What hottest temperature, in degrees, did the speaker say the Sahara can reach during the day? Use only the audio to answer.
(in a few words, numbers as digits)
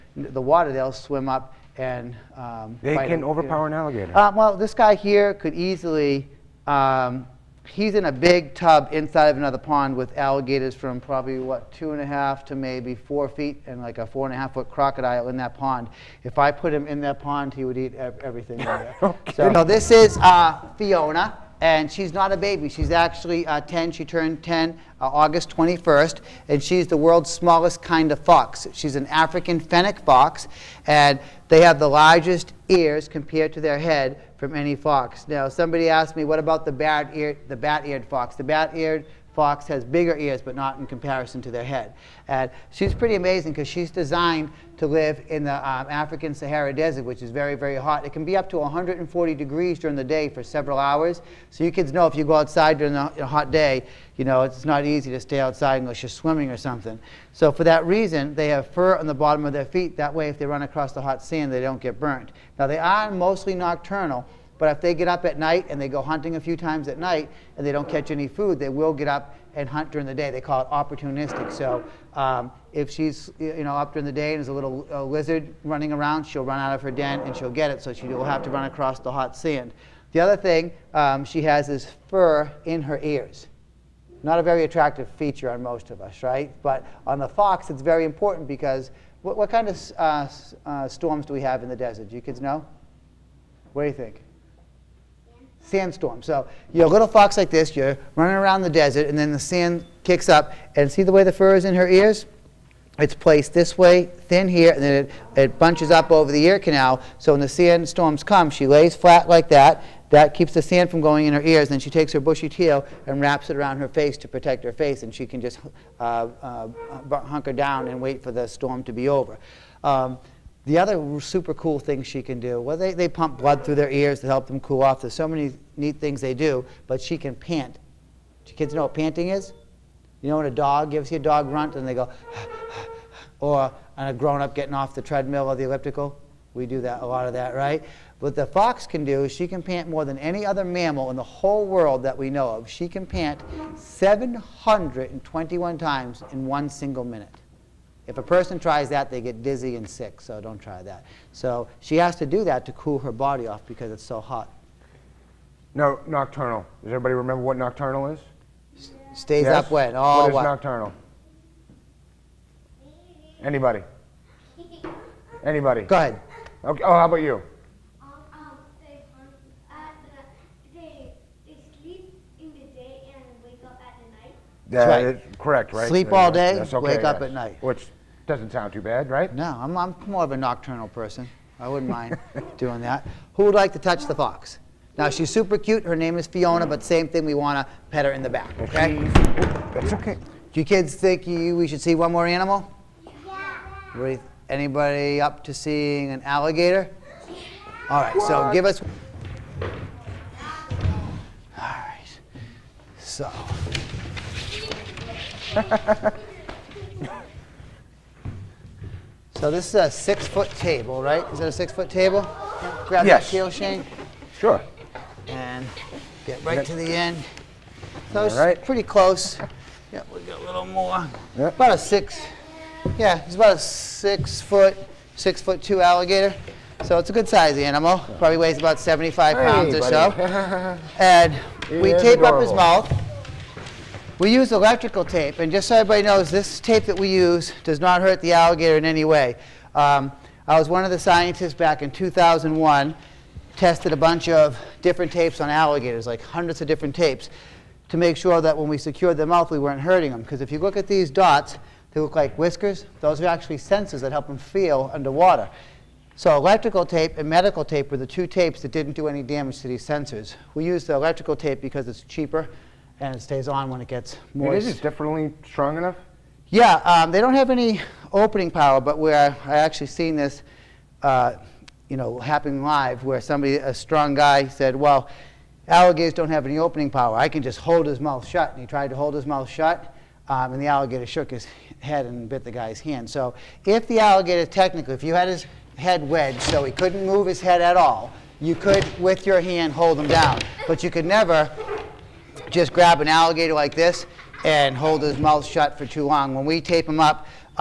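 140 degrees.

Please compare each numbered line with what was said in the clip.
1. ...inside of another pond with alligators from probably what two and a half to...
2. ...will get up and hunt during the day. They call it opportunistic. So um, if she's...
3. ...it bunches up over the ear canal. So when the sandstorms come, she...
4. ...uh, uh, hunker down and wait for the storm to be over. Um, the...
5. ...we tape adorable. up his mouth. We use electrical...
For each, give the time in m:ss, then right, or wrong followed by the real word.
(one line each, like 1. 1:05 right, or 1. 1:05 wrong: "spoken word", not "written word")
1. 0:08 right
2. 1:08 right
3. 1:45 right
4. 1:55 right
5. 3:51 right.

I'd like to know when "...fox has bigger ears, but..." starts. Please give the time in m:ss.
0:39.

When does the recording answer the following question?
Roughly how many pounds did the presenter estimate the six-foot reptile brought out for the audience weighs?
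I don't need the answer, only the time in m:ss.
3:48.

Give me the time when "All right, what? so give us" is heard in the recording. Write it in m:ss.
3:17.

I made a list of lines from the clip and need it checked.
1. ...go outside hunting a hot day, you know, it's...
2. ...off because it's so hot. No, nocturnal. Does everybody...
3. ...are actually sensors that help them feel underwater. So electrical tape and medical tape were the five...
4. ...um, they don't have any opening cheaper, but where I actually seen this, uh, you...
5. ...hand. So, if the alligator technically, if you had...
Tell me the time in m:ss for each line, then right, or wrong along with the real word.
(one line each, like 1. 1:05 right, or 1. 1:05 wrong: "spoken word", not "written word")
1. 0:52 wrong: "during", not "hunting"
2. 2:33 right
3. 4:13 wrong: "two", not "five"
4. 4:26 wrong: "power", not "cheaper"
5. 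4:42 right.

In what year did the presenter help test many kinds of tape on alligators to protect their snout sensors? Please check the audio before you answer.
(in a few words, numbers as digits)
2001.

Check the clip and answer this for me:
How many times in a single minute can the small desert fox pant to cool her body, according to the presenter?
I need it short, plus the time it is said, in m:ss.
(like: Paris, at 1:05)
721, at 2:23.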